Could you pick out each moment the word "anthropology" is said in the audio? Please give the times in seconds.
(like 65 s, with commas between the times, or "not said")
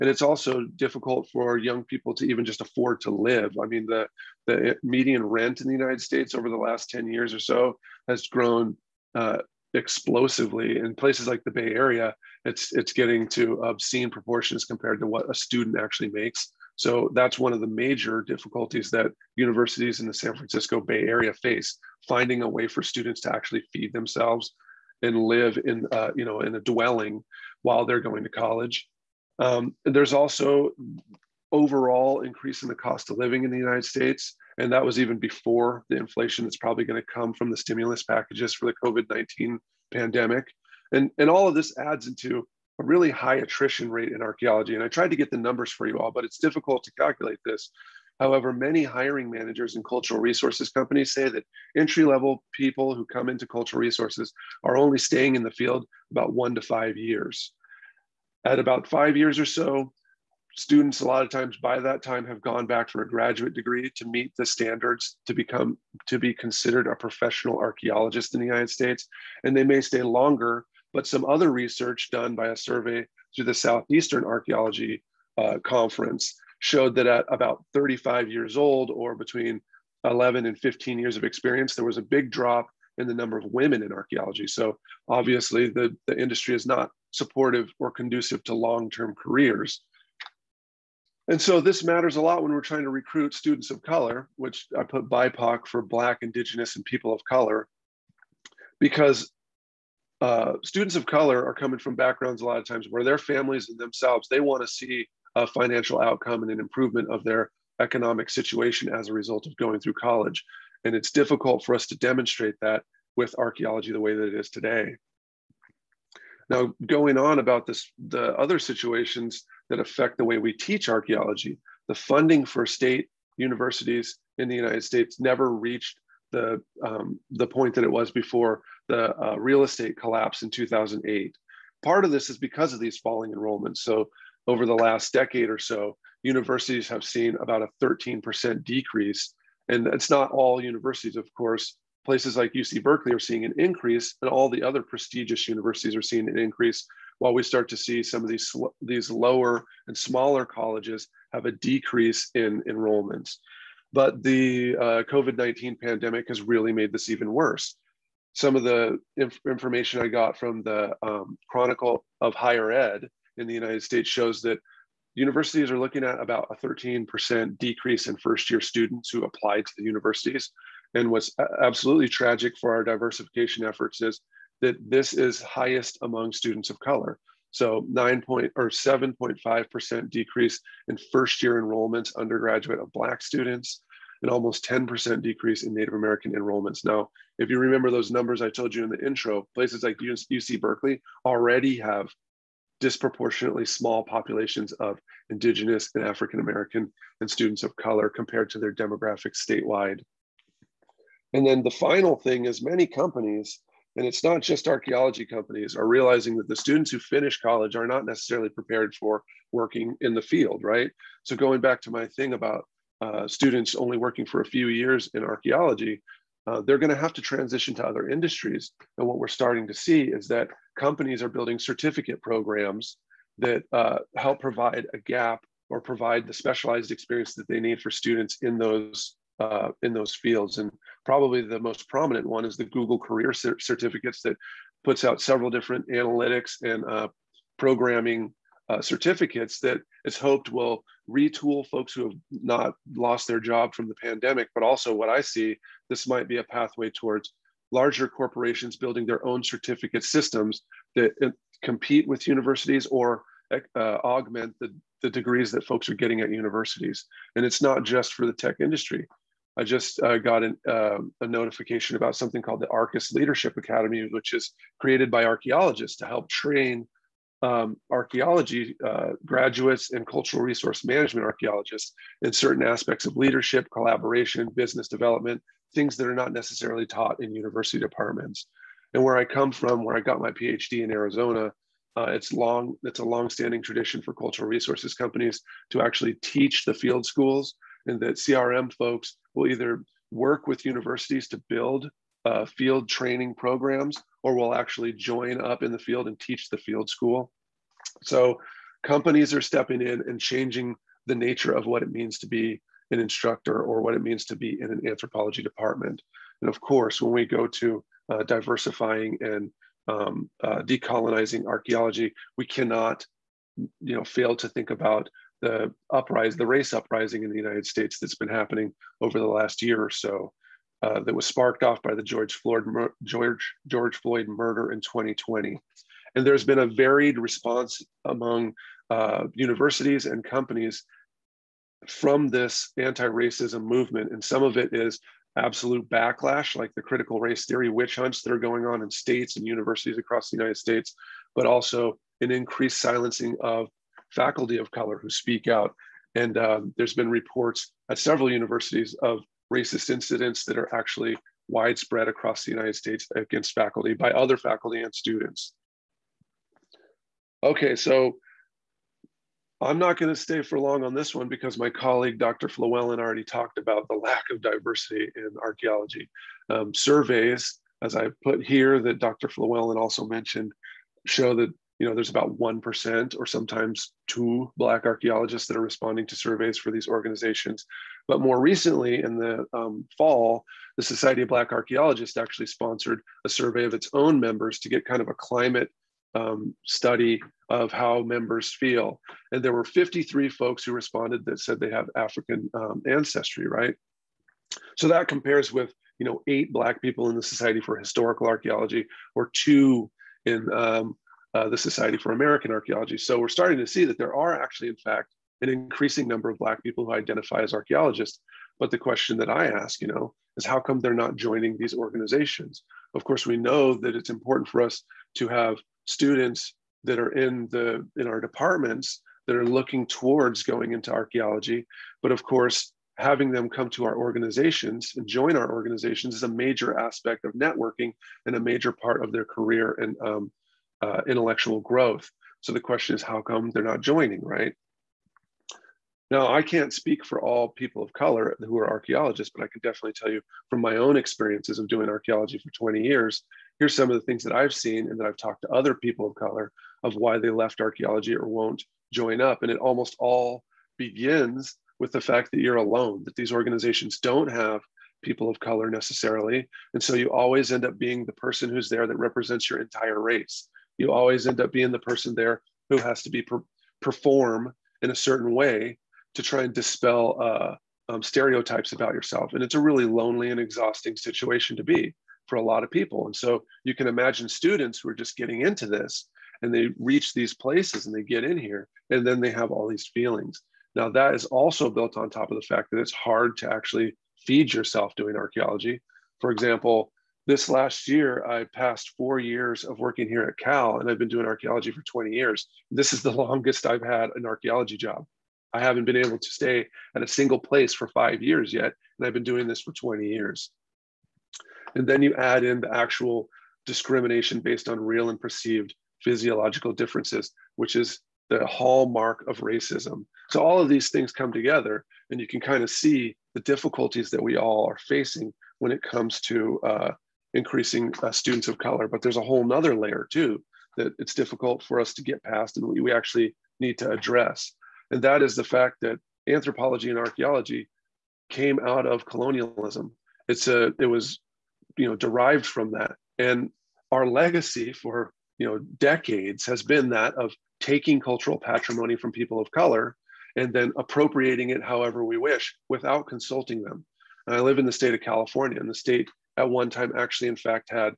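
304 s, 526 s.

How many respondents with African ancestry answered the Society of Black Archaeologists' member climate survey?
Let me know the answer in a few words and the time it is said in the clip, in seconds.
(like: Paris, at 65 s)
53, at 389 s.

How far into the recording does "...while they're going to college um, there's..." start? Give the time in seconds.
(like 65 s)
27 s.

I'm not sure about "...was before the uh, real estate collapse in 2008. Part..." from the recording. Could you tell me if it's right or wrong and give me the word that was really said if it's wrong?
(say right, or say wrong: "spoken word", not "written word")
right.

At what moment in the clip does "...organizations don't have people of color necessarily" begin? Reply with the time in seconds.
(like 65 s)
453 s.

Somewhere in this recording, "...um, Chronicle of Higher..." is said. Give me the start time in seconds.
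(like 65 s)
161 s.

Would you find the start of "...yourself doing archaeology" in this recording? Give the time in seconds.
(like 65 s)
484 s.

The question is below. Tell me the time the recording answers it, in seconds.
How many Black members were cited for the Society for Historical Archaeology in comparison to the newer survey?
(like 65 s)
396 s.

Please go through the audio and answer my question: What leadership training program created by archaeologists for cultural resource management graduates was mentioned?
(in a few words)
Arcus Leadership Academy.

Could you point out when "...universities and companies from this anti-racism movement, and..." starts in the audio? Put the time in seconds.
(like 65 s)
329 s.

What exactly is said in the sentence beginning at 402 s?
So we're starting to see that there are actually, in fact, an increasing number of Black people who identify as archaeologists.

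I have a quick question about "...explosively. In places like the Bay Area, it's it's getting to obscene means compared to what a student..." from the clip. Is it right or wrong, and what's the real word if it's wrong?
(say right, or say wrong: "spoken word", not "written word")
wrong: "proportions", not "means".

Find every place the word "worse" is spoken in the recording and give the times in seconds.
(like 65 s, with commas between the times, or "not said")
157 s.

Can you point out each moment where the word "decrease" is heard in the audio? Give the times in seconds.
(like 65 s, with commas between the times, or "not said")
138 s, 151 s, 167 s, 180 s, 185 s.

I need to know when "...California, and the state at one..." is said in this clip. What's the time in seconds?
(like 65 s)
544 s.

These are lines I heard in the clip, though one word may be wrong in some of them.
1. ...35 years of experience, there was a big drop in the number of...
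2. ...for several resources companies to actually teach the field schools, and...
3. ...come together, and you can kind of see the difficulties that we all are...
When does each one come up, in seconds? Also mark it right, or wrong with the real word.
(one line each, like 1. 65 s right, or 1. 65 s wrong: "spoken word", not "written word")
1. 80 s wrong: "15", not "35"
2. 284 s wrong: "cultural", not "several"
3. 511 s right.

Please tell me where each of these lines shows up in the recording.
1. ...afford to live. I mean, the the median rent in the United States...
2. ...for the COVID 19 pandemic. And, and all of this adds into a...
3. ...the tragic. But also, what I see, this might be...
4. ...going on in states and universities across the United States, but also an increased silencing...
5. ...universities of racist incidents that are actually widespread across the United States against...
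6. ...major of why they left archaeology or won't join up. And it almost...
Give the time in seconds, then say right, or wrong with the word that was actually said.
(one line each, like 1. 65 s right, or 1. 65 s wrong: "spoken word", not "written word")
1. 2 s right
2. 38 s right
3. 243 s wrong: "pandemic", not "tragic"
4. 338 s right
5. 348 s right
6. 446 s wrong: "color", not "major".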